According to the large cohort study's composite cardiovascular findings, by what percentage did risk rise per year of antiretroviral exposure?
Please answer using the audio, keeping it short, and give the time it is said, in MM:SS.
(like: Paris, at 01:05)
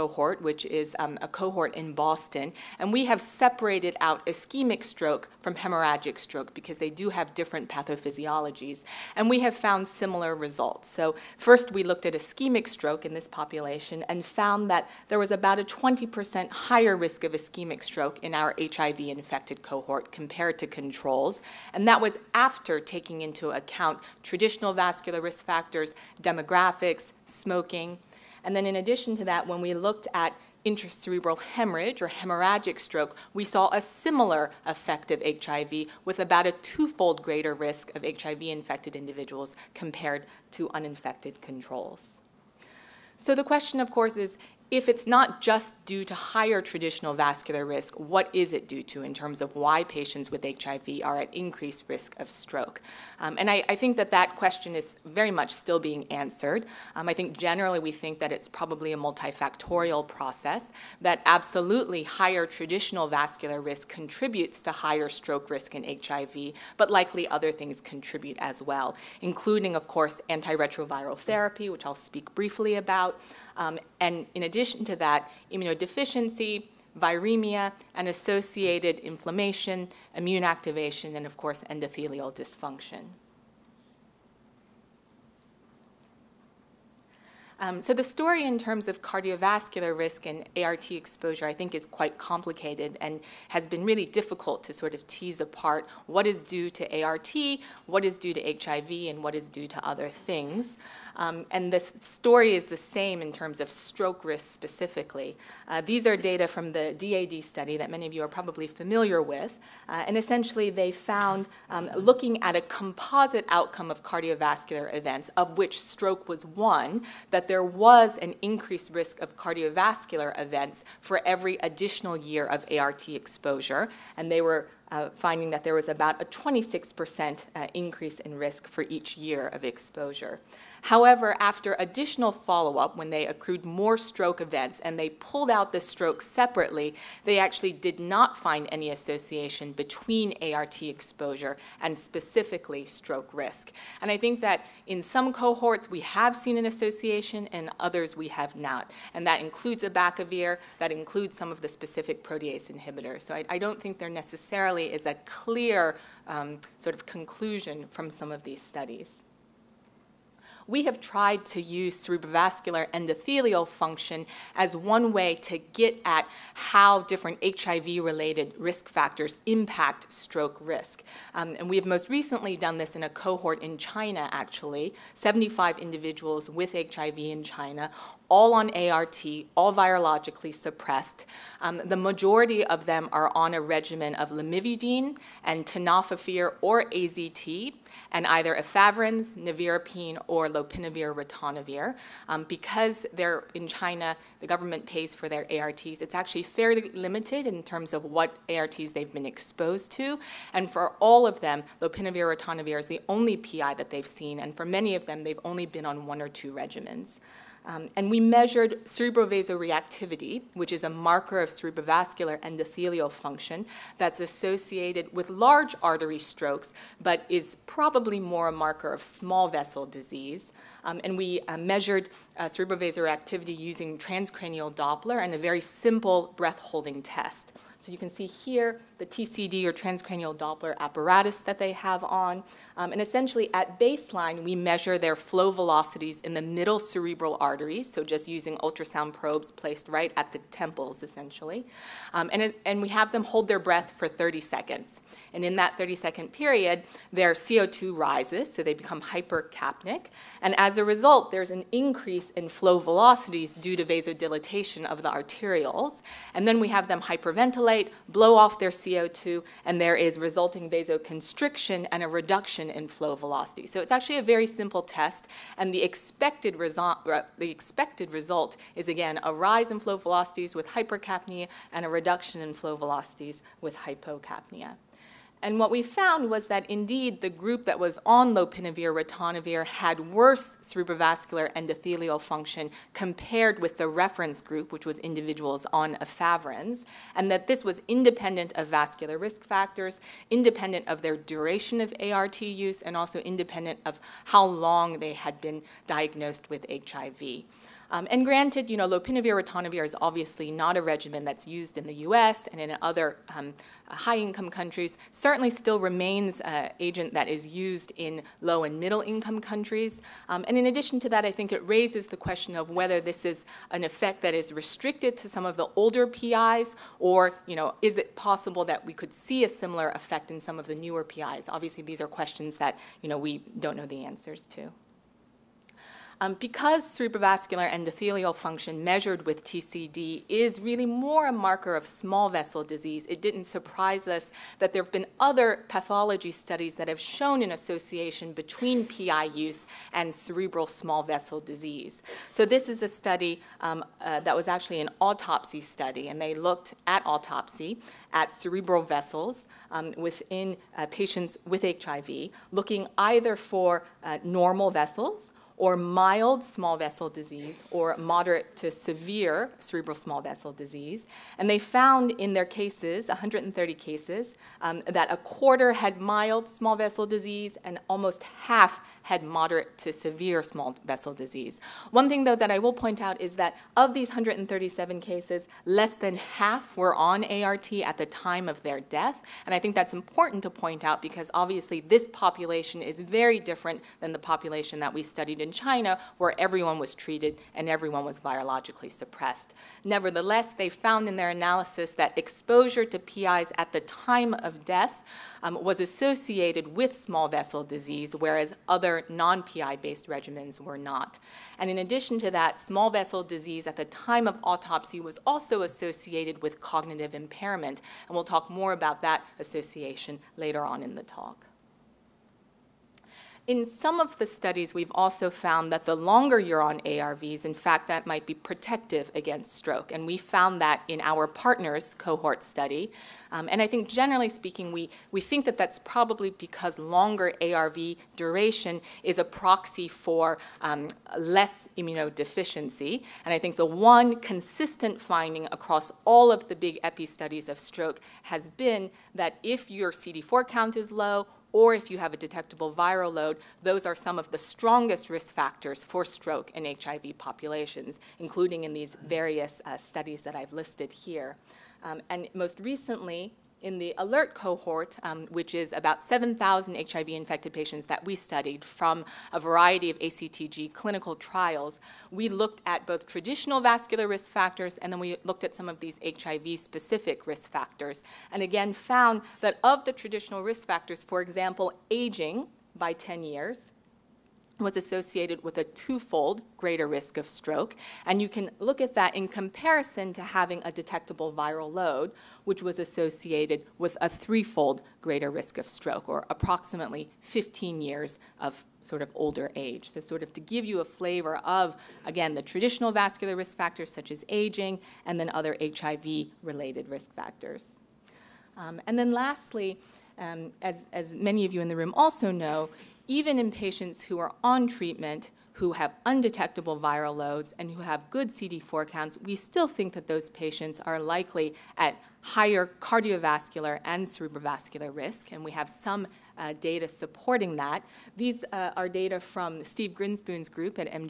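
26%, at 02:06.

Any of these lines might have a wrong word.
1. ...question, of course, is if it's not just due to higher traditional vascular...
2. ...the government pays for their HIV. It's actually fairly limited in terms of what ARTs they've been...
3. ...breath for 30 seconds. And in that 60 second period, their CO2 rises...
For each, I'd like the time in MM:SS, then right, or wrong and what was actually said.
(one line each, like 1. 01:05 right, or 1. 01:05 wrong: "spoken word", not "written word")
1. 00:43 right
2. 03:14 wrong: "ARTs", not "HIV"
3. 04:03 wrong: "30", not "60".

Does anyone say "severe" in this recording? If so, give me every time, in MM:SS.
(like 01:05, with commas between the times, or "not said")
05:58, 06:09.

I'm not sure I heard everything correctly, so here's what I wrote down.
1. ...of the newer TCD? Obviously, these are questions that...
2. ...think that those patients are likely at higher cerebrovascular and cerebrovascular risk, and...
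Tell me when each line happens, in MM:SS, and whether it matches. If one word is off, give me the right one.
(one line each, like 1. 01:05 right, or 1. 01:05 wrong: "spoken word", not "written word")
1. 05:20 wrong: "PIs", not "TCD"
2. 08:29 wrong: "cardiovascular", not "cerebrovascular".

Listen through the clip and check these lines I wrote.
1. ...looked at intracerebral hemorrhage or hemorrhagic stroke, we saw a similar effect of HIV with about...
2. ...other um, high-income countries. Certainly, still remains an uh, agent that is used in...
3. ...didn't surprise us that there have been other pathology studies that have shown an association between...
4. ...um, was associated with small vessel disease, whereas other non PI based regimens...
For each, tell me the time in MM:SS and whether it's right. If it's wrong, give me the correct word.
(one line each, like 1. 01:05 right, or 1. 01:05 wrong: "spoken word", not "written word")
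1. 00:29 right
2. 05:02 right
3. 05:33 right
4. 06:35 right.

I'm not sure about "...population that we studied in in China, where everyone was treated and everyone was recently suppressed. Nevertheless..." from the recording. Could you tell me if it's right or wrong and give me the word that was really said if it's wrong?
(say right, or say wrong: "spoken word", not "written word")
wrong: "virologically", not "recently".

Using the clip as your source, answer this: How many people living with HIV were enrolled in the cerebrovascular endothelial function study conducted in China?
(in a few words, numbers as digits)
75.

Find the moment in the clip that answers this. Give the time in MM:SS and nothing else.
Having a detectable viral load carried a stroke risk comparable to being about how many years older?
08:07.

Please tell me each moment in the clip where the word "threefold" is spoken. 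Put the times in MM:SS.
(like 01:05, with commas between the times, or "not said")
08:04.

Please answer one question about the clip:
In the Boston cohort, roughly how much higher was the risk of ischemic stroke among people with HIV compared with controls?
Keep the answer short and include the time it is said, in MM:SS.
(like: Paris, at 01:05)
20%, at 00:15.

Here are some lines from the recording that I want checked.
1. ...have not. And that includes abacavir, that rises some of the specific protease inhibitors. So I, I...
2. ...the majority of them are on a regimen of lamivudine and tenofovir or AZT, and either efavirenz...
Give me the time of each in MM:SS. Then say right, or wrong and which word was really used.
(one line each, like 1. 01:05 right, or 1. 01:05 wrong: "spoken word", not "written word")
1. 02:28 wrong: "includes", not "rises"
2. 03:01 right.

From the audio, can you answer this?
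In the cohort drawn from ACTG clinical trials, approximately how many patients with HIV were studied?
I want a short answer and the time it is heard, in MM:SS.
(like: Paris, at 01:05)
7,000, at 07:36.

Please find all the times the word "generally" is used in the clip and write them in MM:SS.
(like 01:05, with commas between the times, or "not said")
00:57, 07:03.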